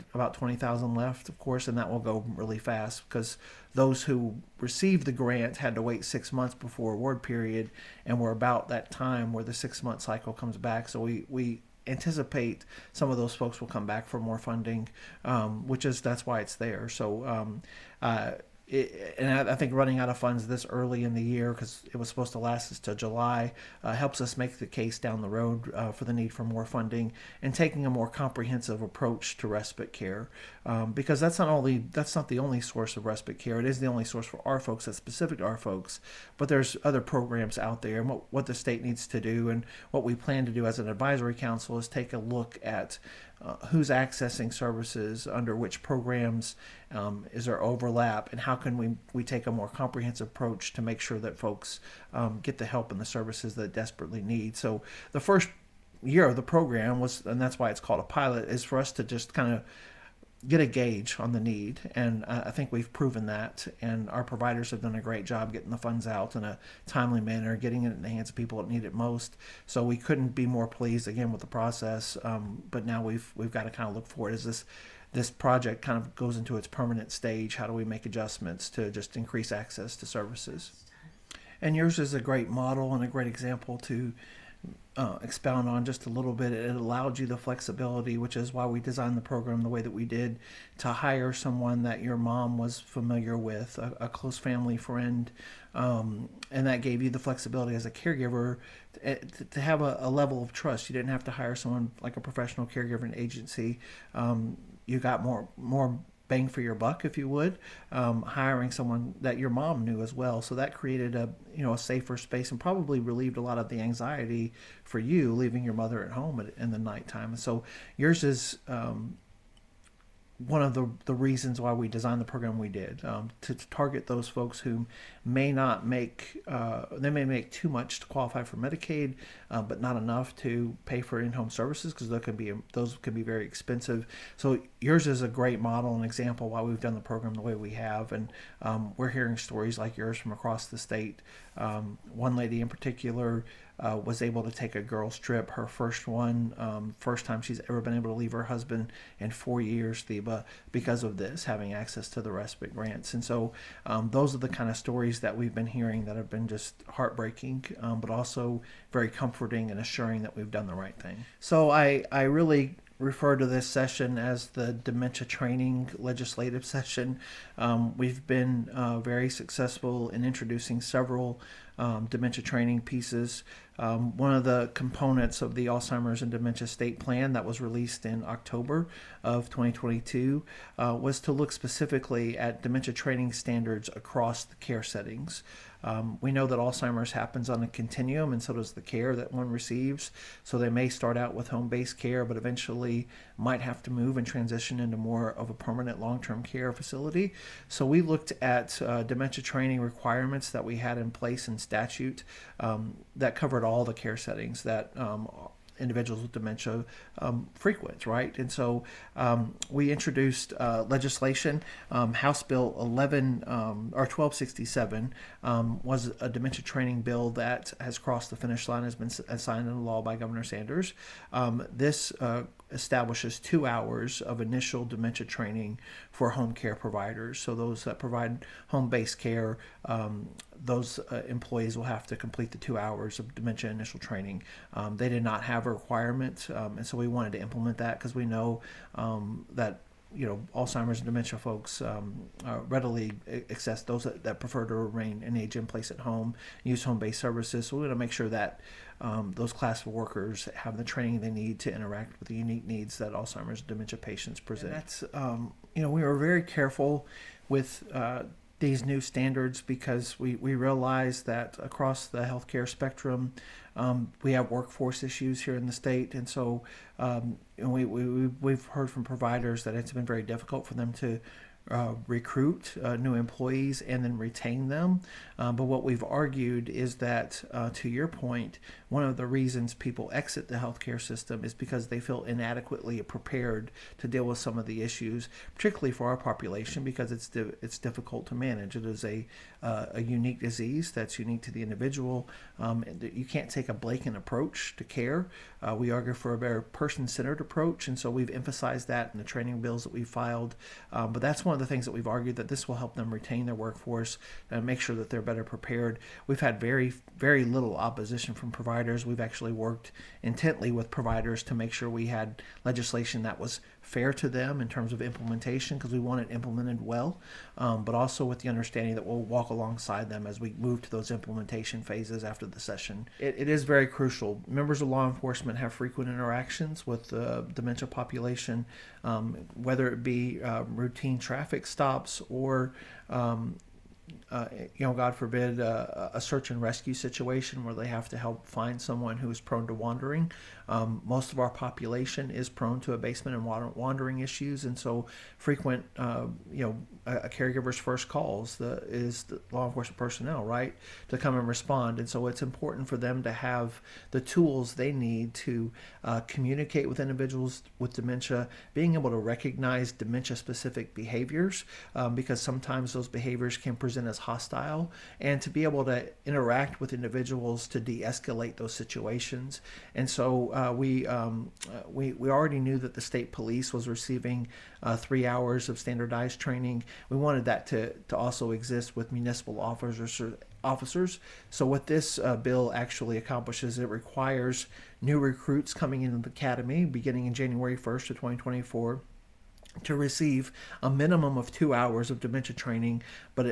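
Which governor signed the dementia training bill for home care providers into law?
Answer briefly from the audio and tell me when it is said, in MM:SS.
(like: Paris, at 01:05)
Governor Sanders, at 03:40.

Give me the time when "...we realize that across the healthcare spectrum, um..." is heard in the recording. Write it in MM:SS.
04:20.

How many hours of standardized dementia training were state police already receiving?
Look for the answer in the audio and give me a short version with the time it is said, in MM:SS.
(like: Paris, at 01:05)
3, at 06:14.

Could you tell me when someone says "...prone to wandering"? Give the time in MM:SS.
05:39.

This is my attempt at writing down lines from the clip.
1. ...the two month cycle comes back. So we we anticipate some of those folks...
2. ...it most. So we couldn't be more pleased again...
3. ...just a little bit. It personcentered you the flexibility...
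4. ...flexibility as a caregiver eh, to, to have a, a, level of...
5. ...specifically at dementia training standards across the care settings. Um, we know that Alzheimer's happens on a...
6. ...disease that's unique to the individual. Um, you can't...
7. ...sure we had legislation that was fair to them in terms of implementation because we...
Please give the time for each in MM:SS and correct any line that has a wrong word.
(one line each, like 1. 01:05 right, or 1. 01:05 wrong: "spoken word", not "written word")
1. 00:09 wrong: "six", not "two"
2. 01:08 right
3. 01:25 wrong: "allowed", not "personcentered"
4. 01:37 right
5. 03:01 right
6. 04:50 right
7. 05:11 right.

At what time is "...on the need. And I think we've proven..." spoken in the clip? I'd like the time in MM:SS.
01:01.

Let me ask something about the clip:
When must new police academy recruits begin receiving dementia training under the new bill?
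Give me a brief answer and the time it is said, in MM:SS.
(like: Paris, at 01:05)
January 1, 2024, at 06:27.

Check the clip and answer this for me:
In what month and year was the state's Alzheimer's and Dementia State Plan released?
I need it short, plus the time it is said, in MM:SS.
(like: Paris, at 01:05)
October 2022, at 02:58.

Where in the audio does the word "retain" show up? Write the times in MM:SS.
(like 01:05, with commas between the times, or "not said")
04:34, 05:03.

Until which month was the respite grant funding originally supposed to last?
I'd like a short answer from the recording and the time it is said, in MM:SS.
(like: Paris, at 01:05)
July, at 00:22.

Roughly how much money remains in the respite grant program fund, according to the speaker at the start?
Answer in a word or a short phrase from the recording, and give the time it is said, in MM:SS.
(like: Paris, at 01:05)
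20,000, at 00:00.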